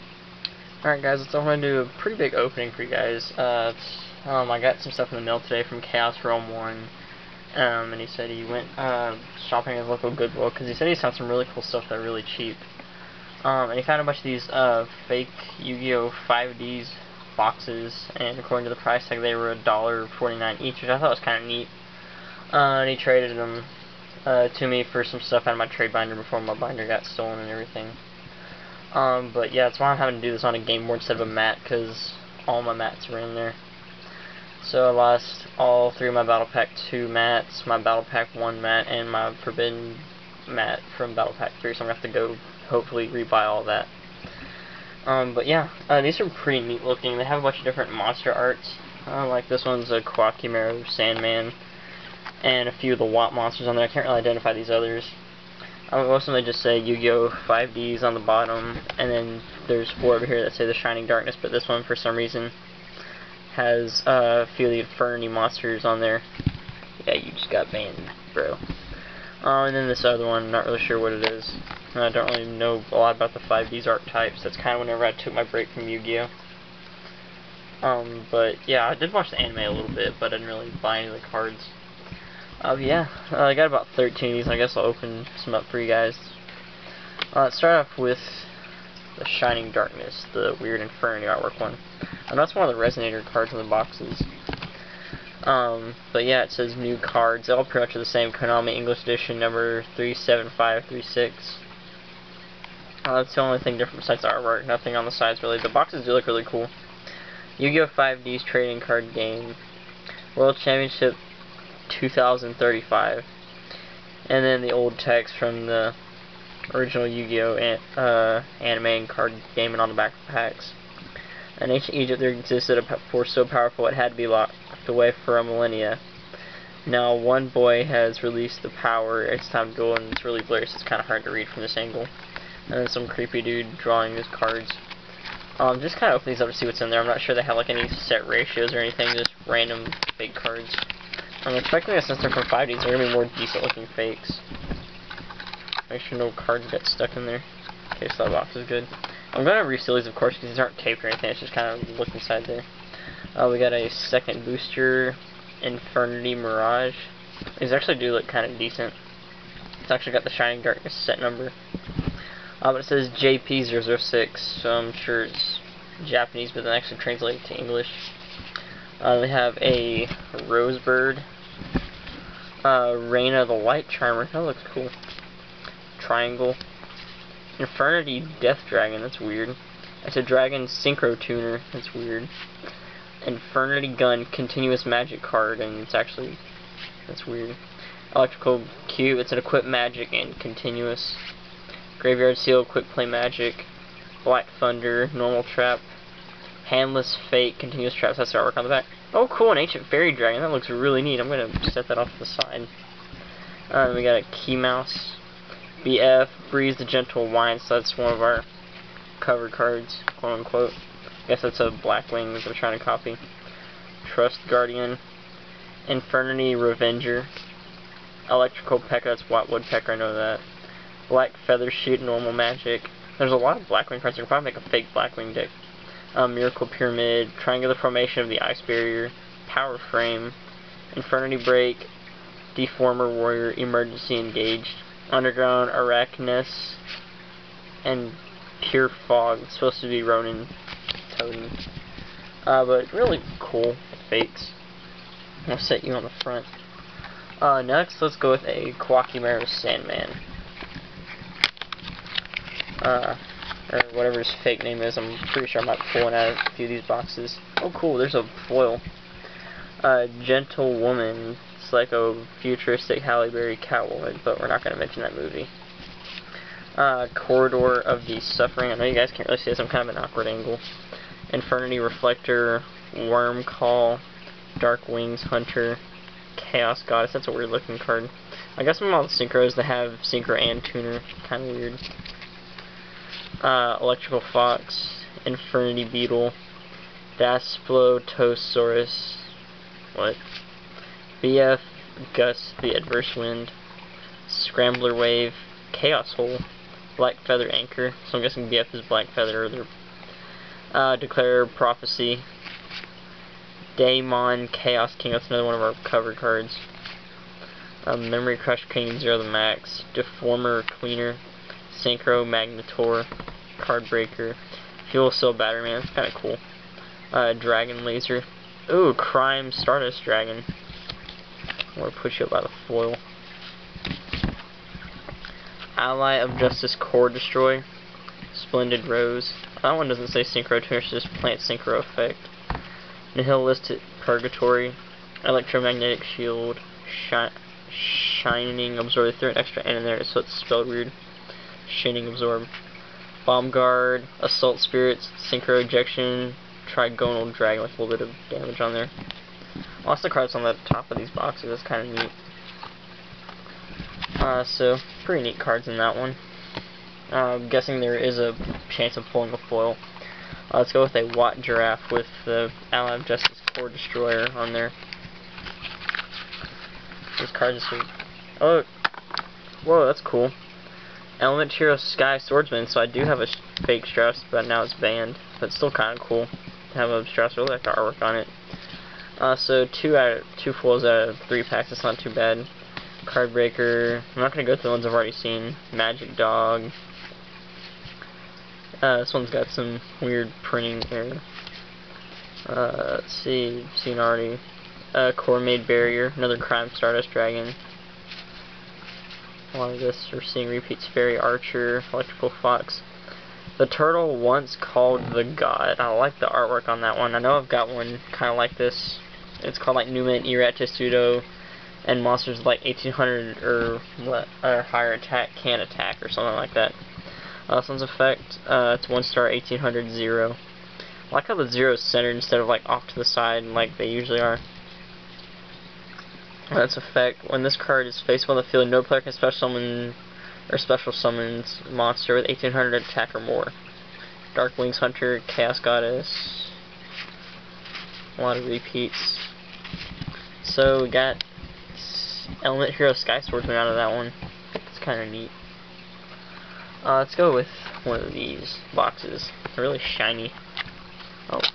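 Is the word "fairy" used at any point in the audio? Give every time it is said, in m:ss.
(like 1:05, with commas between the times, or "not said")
3:19, 6:40.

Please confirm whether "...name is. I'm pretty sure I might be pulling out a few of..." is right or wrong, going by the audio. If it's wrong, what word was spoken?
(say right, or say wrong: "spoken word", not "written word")
right.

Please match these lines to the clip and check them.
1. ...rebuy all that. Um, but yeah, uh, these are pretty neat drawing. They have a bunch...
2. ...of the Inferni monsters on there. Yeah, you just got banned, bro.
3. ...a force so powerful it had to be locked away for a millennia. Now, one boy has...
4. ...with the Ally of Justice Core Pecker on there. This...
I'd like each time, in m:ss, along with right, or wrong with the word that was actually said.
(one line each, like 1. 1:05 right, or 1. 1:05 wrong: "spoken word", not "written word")
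1. 0:43 wrong: "looking", not "drawing"
2. 1:04 right
3. 2:02 right
4. 6:01 wrong: "Destroyer", not "Pecker".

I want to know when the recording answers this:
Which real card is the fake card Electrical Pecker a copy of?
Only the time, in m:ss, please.
3:39.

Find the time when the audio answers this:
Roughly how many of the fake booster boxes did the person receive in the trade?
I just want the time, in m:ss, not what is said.
1:23.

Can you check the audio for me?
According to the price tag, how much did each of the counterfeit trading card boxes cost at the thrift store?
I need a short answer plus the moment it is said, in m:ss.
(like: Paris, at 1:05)
$1.49, at 0:19.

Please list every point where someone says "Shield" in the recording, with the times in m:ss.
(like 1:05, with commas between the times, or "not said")
5:36.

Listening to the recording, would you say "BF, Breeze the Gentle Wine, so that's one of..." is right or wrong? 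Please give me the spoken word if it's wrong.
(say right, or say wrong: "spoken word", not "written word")
right.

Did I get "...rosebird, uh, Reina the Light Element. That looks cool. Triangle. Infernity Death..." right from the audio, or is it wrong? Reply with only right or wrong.
wrong.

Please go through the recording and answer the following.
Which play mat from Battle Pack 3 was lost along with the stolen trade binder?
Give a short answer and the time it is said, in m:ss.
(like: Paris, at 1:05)
Forbidden mat, at 0:39.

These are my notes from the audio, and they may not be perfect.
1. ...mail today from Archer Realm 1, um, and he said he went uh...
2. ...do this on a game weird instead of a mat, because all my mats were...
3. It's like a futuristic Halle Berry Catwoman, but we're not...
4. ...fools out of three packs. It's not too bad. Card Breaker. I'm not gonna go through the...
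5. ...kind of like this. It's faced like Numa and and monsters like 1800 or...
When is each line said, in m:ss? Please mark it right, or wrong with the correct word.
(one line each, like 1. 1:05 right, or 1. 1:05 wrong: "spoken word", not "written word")
1. 0:05 wrong: "Chaos", not "Archer"
2. 0:30 wrong: "board", not "weird"
3. 4:21 right
4. 6:20 right
5. 6:48 wrong: "called", not "faced".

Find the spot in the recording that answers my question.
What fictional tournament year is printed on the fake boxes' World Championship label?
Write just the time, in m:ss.
1:51.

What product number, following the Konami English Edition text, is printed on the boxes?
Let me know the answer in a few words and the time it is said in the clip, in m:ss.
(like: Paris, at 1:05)
37536, at 1:39.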